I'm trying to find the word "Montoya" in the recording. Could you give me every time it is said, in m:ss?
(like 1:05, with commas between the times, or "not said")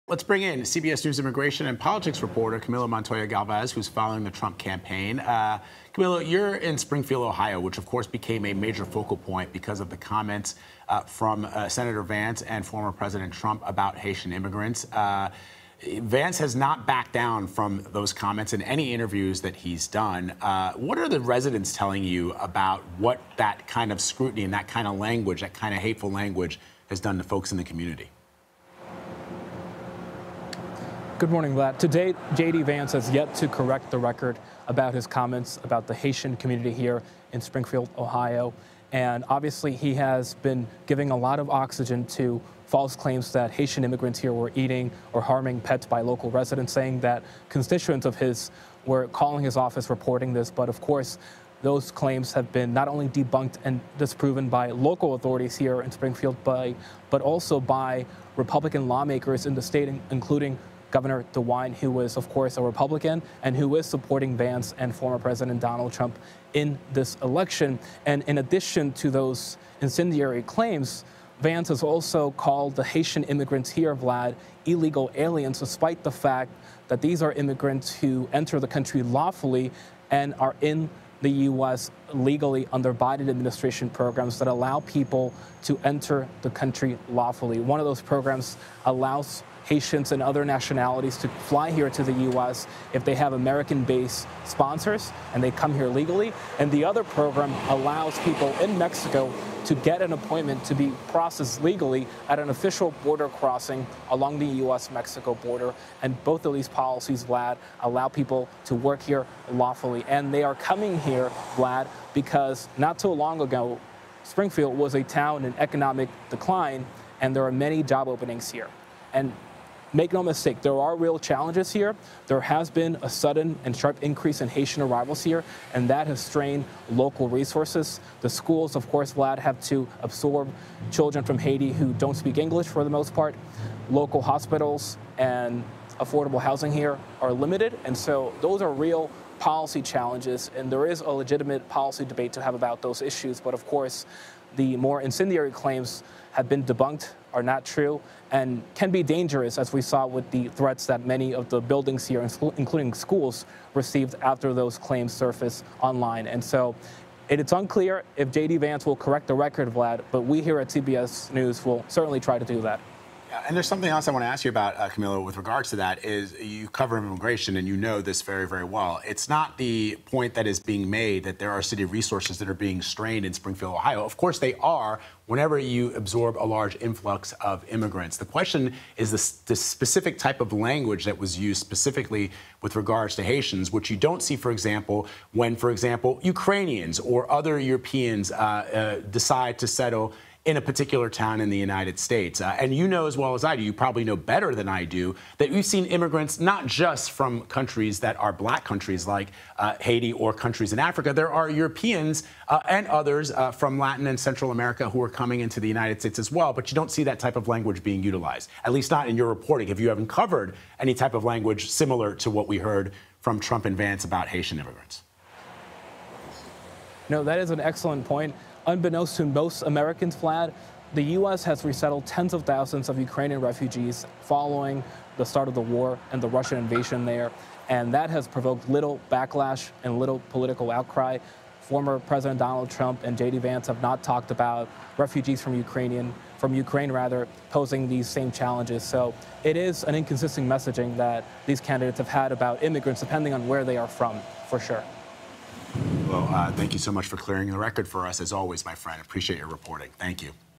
0:02.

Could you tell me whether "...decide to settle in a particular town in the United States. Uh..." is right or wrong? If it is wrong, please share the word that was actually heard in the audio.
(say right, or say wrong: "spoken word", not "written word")
right.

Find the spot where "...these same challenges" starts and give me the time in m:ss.
3:57.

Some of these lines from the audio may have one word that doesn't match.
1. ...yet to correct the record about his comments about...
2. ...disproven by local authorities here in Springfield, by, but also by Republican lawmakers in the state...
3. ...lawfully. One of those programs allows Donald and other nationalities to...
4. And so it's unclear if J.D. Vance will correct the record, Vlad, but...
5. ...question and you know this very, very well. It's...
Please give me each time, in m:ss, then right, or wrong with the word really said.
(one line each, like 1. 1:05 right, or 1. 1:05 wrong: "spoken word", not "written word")
1. 0:33 right
2. 0:53 right
3. 1:27 wrong: "Haitians", not "Donald"
4. 2:36 right
5. 2:46 wrong: "immigration", not "question".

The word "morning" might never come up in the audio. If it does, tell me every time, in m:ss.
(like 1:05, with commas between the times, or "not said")
0:31.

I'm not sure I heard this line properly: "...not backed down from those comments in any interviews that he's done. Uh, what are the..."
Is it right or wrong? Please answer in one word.
right.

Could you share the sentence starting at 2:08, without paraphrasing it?
The schools, of course, Vlad, have to absorb children from Haiti who don't speak English for the most part.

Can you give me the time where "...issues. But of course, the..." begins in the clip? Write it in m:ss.
2:23.